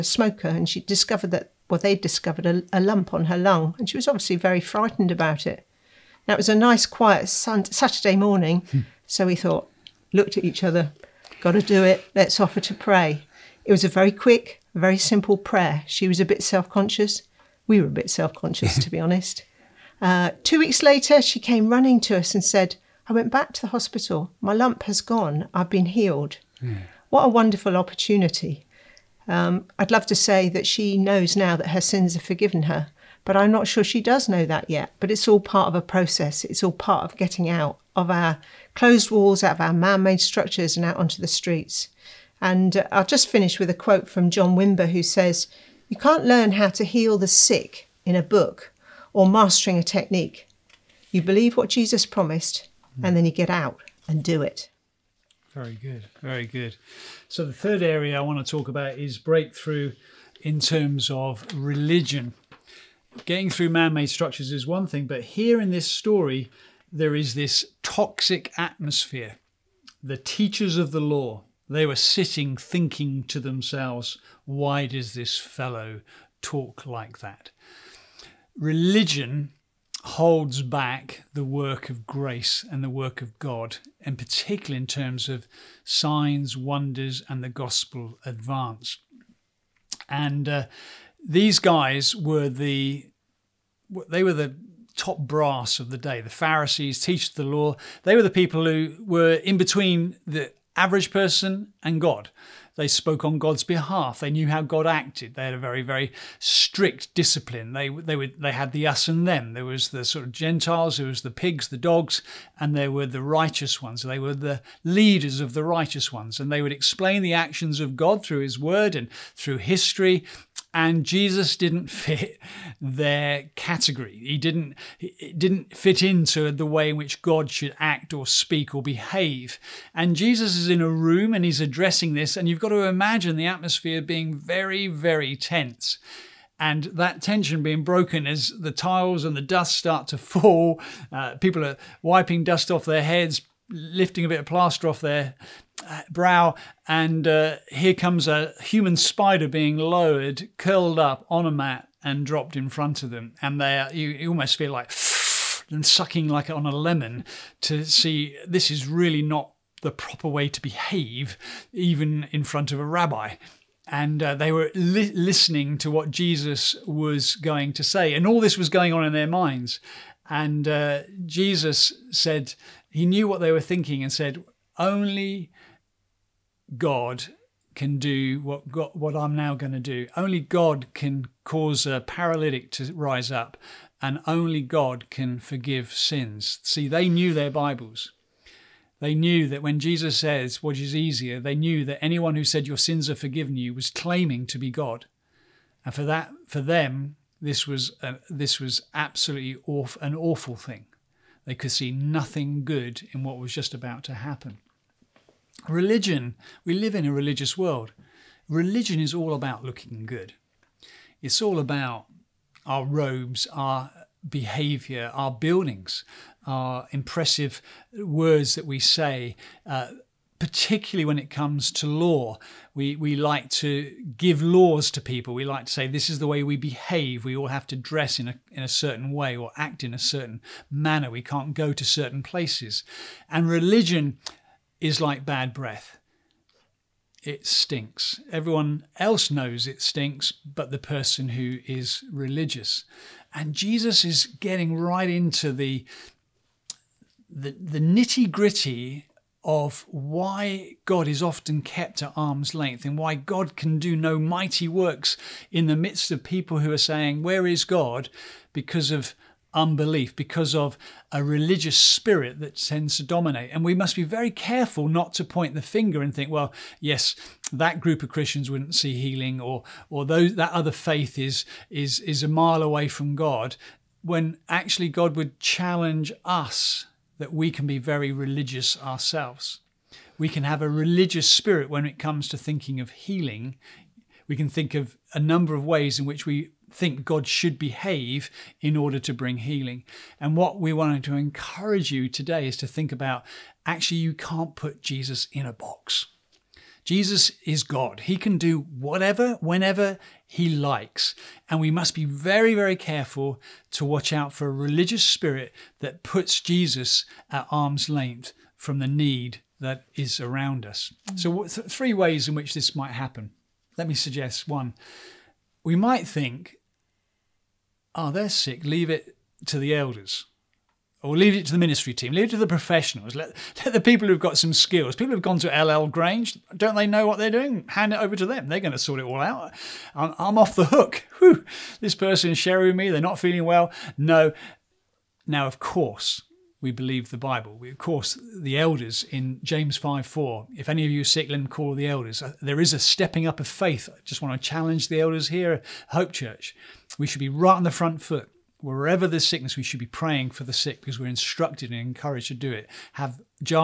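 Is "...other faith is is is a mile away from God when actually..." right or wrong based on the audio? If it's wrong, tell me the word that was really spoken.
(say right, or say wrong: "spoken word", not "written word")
right.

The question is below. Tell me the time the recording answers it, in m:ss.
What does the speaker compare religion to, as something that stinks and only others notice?
3:55.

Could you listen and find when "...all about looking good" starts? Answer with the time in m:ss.
3:29.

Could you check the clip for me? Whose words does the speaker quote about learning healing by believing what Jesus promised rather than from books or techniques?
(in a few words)
John Wimber.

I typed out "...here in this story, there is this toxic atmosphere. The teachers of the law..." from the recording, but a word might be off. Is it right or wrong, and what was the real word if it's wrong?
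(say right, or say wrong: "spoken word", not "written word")
right.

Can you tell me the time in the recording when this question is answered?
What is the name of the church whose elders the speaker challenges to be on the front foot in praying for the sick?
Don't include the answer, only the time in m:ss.
5:45.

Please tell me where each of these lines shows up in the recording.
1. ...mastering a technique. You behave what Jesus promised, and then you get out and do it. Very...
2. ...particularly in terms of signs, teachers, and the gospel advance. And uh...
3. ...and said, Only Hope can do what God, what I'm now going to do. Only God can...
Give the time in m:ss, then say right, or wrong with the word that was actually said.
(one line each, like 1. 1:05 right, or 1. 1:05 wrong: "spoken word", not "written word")
1. 0:49 wrong: "believe", not "behave"
2. 1:24 wrong: "wonders", not "teachers"
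3. 2:54 wrong: "God", not "Hope".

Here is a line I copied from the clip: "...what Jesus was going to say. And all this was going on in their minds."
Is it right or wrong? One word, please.
right.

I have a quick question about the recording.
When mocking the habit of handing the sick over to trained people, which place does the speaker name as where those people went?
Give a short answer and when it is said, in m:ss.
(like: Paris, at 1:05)
Ellel Grange, at 5:25.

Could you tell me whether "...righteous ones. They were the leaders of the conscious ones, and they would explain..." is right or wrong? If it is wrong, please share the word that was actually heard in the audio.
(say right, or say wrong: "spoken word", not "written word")
wrong: "righteous", not "conscious".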